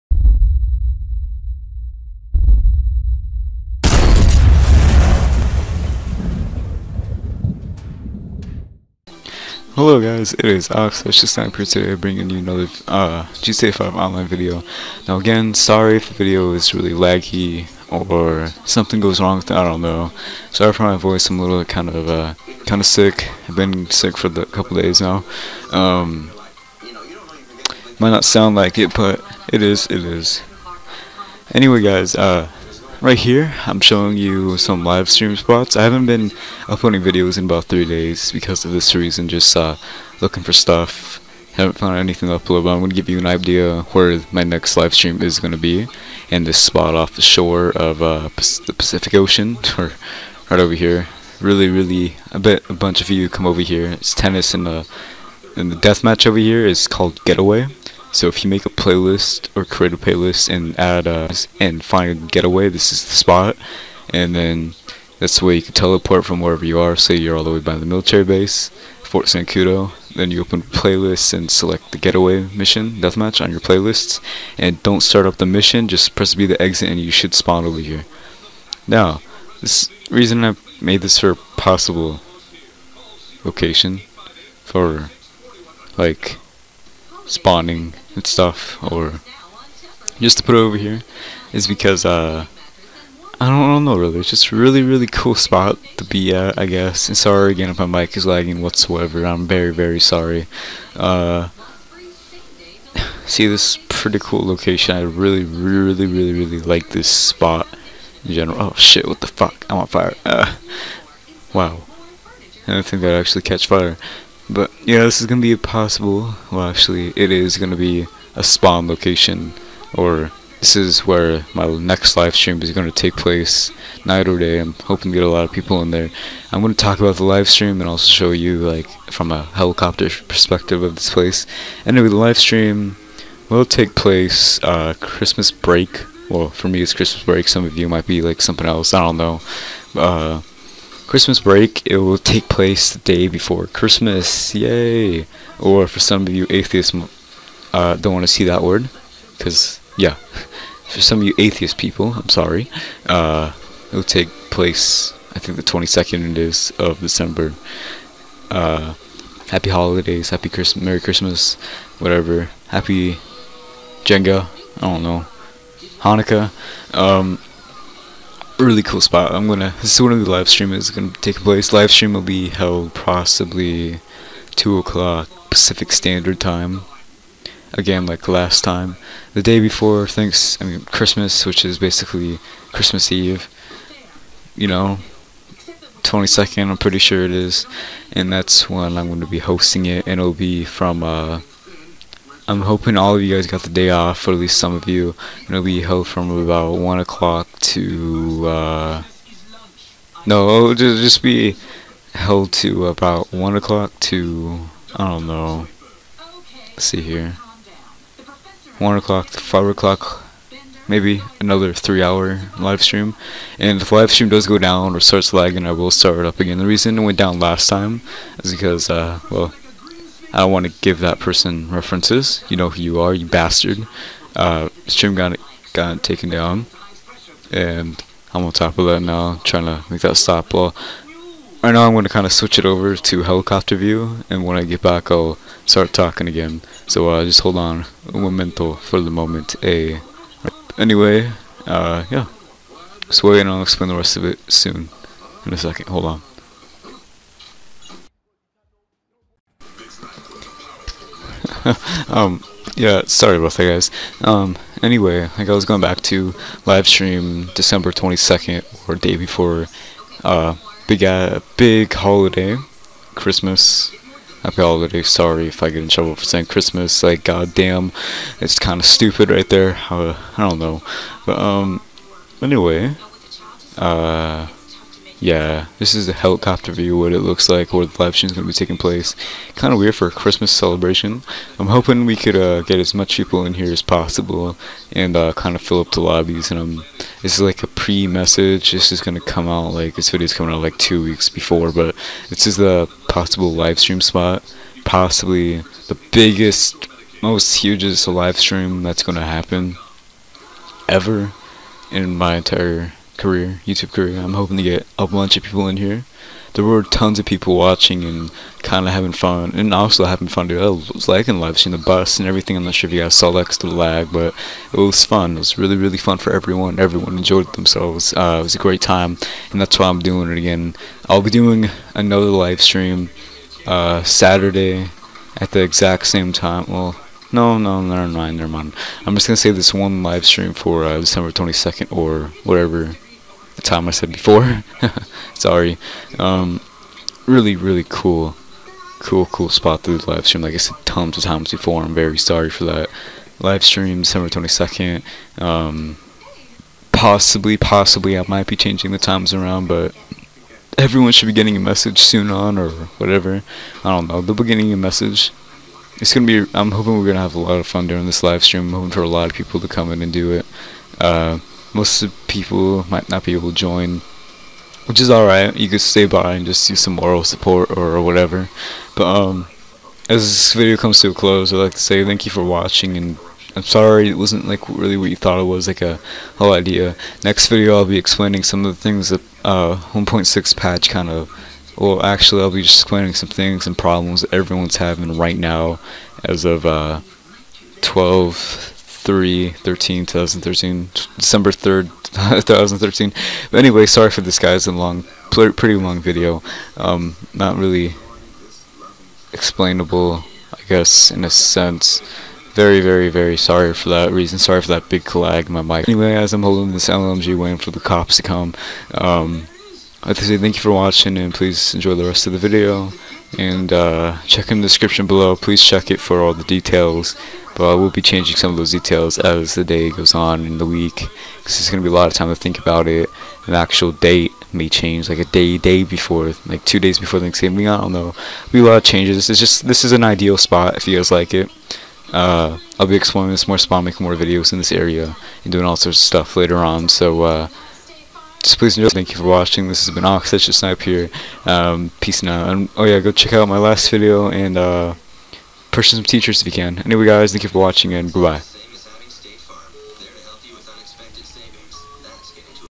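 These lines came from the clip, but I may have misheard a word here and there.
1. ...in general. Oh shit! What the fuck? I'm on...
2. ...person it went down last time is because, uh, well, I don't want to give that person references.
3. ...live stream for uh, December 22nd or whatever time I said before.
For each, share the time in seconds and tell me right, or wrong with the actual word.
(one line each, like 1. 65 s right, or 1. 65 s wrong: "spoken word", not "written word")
1. 108 s right
2. 216 s wrong: "reason", not "person"
3. 330 s right.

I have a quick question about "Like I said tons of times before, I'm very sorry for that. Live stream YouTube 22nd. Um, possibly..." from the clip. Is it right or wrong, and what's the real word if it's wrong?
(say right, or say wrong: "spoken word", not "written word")
wrong: "December", not "YouTube".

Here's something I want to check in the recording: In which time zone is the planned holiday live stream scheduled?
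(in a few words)
Pacific Standard Time.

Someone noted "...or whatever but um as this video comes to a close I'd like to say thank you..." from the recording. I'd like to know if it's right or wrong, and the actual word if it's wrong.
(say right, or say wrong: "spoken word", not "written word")
right.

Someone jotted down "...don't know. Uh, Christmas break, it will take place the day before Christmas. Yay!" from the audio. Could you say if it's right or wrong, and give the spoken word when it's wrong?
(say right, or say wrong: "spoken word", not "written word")
right.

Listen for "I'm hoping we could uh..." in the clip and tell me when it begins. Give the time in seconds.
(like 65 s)
281 s.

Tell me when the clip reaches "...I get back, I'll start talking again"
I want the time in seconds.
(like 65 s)
234 s.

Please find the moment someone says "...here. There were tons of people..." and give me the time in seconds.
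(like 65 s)
305 s.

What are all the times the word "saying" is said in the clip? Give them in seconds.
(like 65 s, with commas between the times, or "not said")
266 s.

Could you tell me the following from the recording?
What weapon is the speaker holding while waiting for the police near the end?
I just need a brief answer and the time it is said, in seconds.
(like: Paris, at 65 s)
LMG, at 406 s.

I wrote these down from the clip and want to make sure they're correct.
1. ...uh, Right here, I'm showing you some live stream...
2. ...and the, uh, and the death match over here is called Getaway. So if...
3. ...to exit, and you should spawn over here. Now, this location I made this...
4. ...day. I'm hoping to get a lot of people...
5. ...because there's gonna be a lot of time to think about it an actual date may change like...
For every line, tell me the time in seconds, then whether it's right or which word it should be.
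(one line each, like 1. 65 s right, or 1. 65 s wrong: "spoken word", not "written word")
1. 32 s right
2. 54 s right
3. 76 s wrong: "reason", not "location"
4. 124 s right
5. 421 s right.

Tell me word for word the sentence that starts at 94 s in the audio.
It's just really, really cool spot to be at, I guess.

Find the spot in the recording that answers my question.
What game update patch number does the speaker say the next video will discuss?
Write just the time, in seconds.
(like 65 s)
379 s.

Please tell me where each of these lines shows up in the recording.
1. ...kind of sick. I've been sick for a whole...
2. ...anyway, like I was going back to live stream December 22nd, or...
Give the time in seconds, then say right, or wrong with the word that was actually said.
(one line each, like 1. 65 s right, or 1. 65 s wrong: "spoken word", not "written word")
1. 22 s wrong: "couple", not "whole"
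2. 254 s right.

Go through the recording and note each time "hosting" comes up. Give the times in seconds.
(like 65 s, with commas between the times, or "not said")
189 s.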